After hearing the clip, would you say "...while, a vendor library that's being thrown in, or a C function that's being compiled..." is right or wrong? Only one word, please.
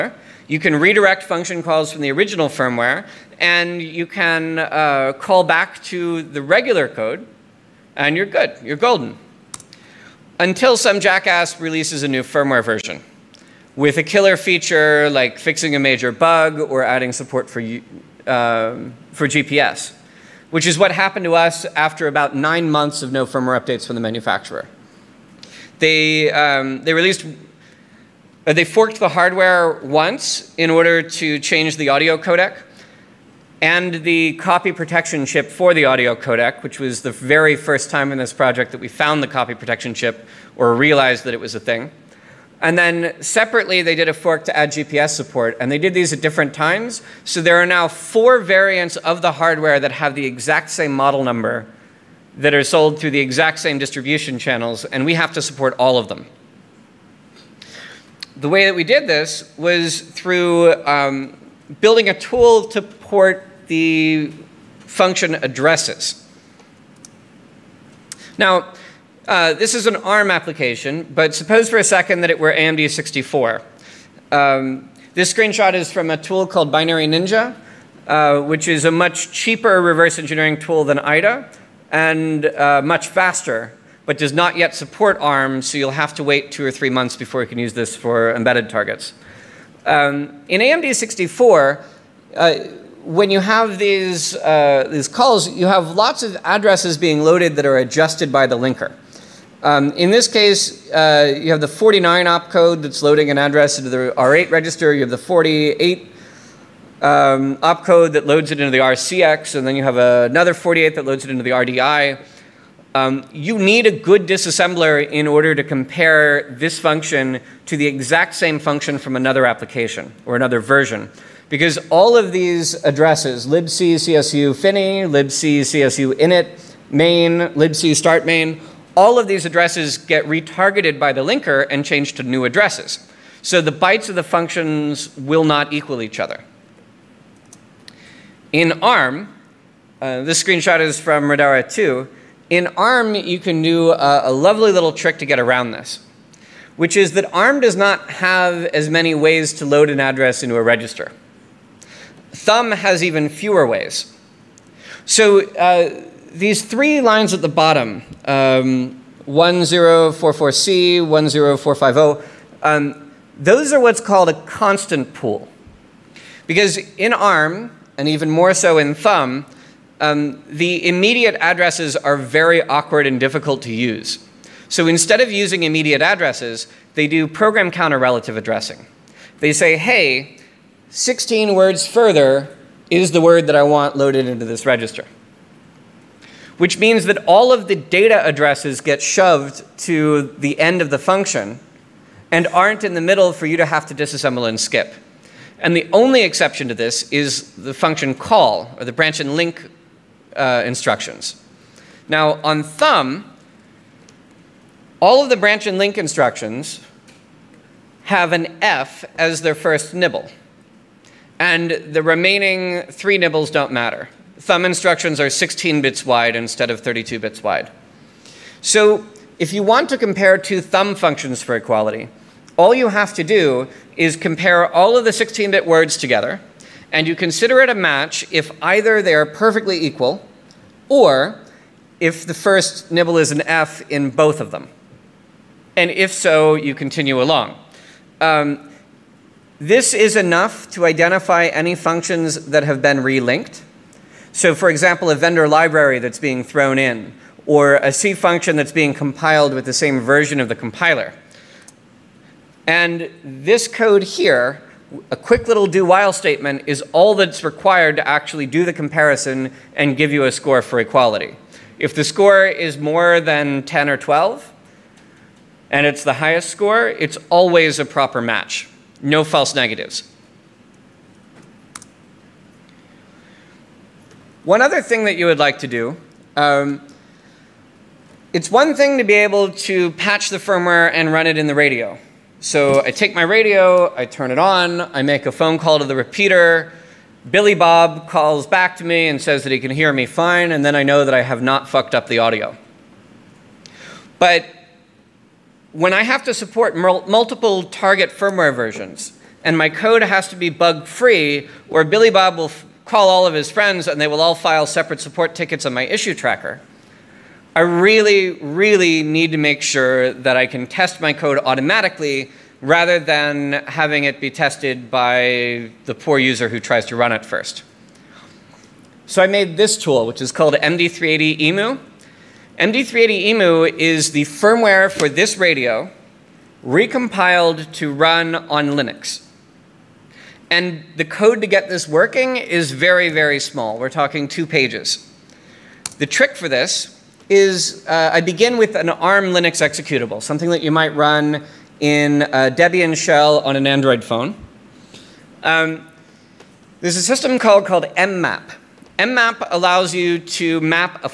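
wrong.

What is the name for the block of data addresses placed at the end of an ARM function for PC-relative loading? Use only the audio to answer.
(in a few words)
constant pool.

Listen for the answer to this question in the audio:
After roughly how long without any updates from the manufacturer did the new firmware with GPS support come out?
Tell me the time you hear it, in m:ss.
0:22.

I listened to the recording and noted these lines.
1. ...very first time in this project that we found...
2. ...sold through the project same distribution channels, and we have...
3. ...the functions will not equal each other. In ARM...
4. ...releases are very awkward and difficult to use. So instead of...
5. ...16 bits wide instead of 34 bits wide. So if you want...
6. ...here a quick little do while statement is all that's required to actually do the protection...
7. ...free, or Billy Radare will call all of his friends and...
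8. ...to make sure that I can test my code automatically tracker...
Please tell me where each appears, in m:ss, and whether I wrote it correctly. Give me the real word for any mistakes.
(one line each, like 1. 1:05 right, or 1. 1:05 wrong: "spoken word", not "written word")
1. 0:37 right
2. 0:52 wrong: "exact", not "project"
3. 2:14 right
4. 2:51 wrong: "addresses", not "releases"
5. 3:35 wrong: "32", not "34"
6. 4:14 wrong: "comparison", not "protection"
7. 5:00 wrong: "Bob", not "Radare"
8. 5:09 wrong: "rather", not "tracker".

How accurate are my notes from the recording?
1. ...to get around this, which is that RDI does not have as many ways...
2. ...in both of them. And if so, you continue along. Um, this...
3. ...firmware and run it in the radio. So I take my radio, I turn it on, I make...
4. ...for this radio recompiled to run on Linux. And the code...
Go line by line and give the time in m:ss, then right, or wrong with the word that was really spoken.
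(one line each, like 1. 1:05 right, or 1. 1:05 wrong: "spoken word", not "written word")
1. 2:25 wrong: "ARM", not "RDI"
2. 3:53 right
3. 4:40 right
4. 5:24 right.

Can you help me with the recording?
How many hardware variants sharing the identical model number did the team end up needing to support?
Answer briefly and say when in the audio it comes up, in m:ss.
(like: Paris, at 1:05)
4, at 0:47.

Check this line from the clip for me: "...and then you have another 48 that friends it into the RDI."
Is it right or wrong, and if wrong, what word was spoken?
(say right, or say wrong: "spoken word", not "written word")
wrong: "loads", not "friends".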